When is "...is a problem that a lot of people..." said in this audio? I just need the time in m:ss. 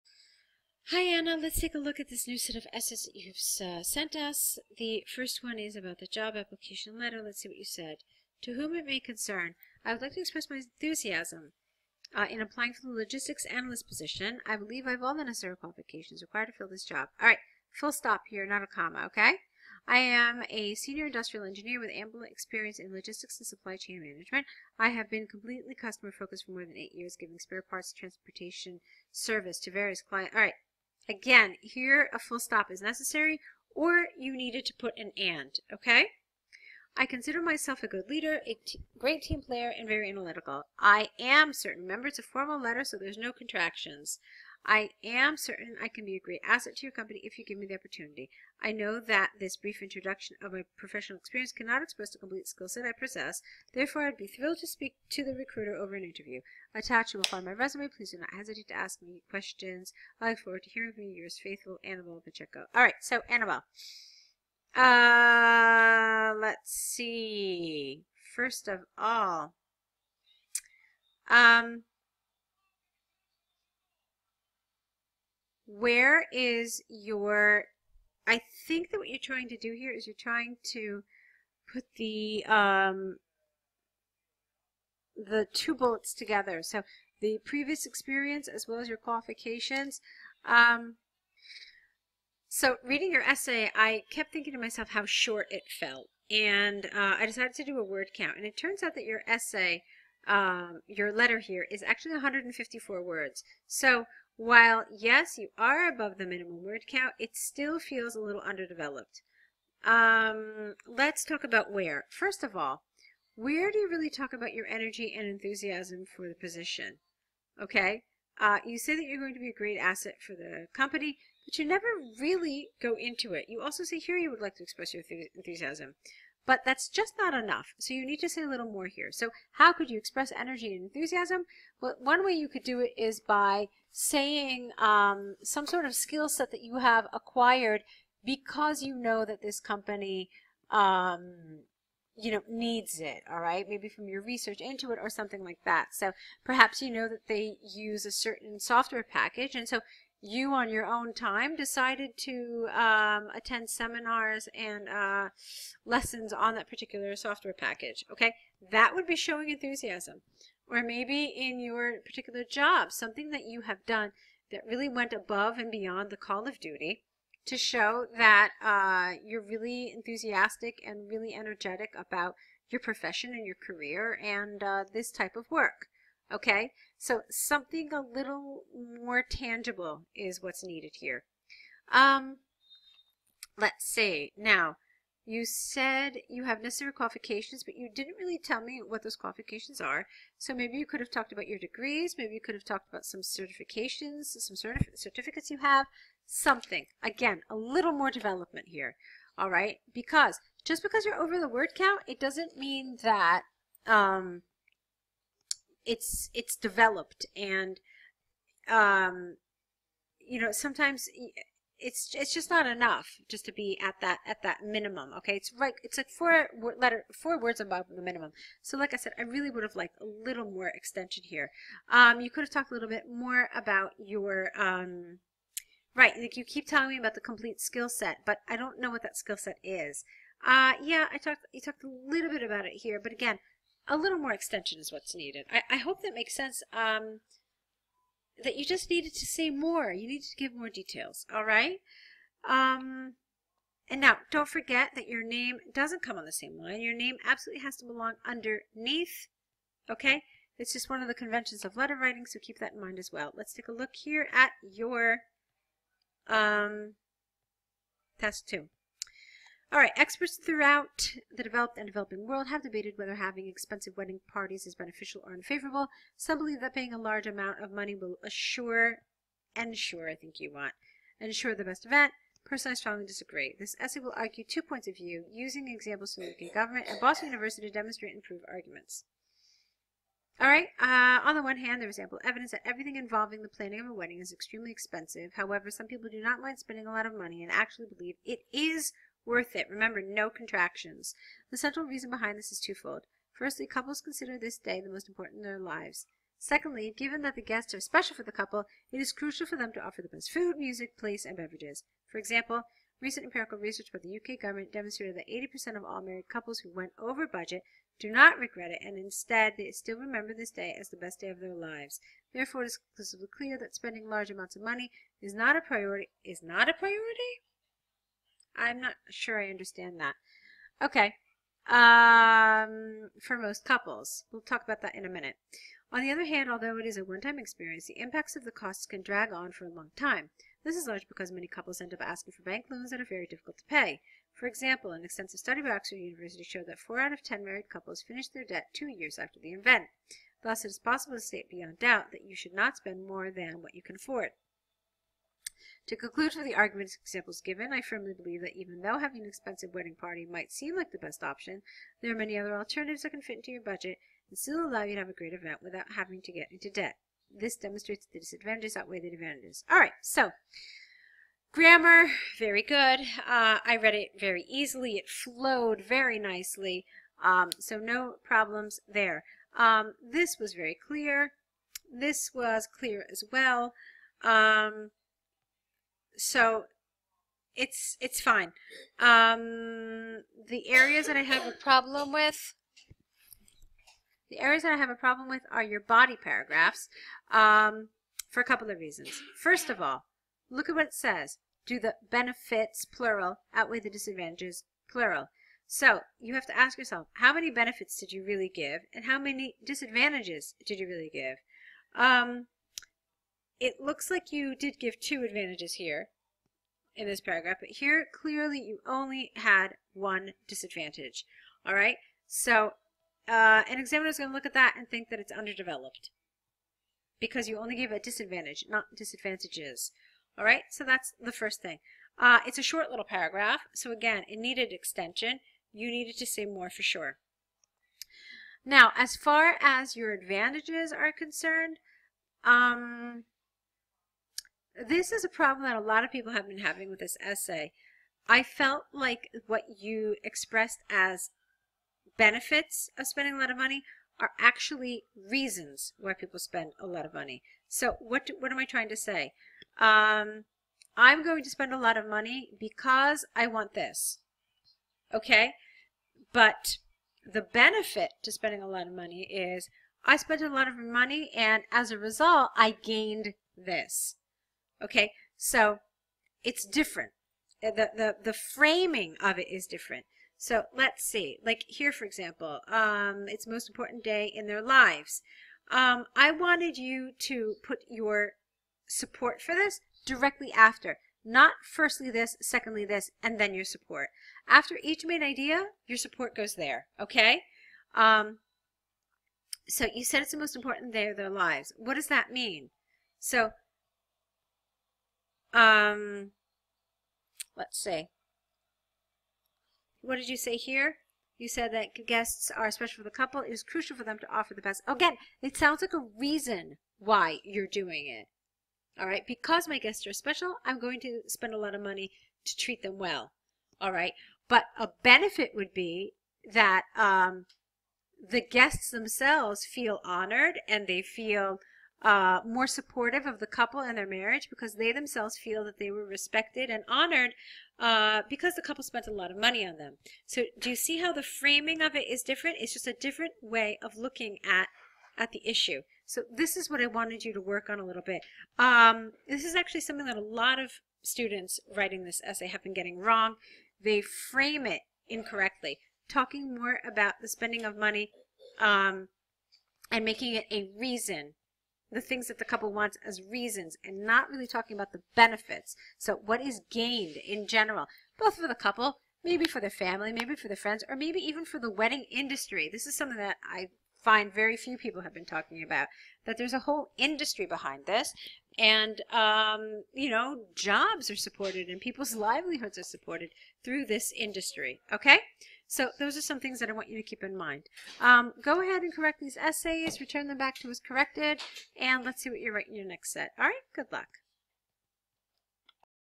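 7:15.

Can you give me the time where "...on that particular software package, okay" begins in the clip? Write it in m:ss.
2:36.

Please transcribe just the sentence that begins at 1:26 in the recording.
So the previous experience as well as your qualifications.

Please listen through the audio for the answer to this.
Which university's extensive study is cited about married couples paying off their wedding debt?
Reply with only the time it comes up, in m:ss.
5:35.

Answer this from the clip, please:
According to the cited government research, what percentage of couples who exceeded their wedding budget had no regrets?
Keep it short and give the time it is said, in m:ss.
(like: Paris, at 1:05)
80%, at 5:05.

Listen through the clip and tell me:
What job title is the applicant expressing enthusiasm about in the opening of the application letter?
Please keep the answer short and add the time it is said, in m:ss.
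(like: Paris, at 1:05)
logistics analyst, at 0:12.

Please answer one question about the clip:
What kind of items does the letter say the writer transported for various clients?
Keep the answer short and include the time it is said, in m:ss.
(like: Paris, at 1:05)
spare parts, at 0:27.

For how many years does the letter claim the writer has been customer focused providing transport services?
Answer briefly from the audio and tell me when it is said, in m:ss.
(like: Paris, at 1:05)
8, at 0:26.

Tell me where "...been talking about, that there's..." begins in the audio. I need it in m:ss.
9:25.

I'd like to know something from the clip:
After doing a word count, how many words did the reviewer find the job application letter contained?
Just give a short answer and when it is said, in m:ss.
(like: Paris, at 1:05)
154, at 1:42.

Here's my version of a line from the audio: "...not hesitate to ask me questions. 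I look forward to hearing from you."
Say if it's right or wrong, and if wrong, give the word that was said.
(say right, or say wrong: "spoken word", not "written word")
right.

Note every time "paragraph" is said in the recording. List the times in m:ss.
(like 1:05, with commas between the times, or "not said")
6:26, 6:47, 7:03.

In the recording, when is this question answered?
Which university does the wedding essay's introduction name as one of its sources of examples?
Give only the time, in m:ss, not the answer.
4:36.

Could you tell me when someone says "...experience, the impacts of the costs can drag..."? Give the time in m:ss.
5:27.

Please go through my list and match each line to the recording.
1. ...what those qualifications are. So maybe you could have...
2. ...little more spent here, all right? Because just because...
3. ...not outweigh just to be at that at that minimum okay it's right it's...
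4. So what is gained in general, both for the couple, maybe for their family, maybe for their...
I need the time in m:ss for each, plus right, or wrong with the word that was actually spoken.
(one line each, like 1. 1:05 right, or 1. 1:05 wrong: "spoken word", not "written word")
1. 3:08 right
2. 3:17 wrong: "development", not "spent"
3. 3:32 wrong: "enough", not "outweigh"
4. 9:15 right.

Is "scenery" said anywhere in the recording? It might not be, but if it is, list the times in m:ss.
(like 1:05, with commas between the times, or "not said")
not said.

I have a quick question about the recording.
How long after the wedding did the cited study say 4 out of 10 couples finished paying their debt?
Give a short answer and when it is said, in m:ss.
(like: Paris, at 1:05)
2 years, at 5:38.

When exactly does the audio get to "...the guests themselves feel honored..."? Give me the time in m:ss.
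8:38.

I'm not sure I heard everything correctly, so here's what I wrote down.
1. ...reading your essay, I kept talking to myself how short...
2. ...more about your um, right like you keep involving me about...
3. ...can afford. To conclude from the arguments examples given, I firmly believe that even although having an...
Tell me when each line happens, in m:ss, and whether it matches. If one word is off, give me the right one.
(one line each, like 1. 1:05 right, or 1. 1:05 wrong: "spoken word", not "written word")
1. 1:32 wrong: "thinking", not "talking"
2. 3:43 wrong: "telling", not "involving"
3. 5:43 wrong: "though", not "although".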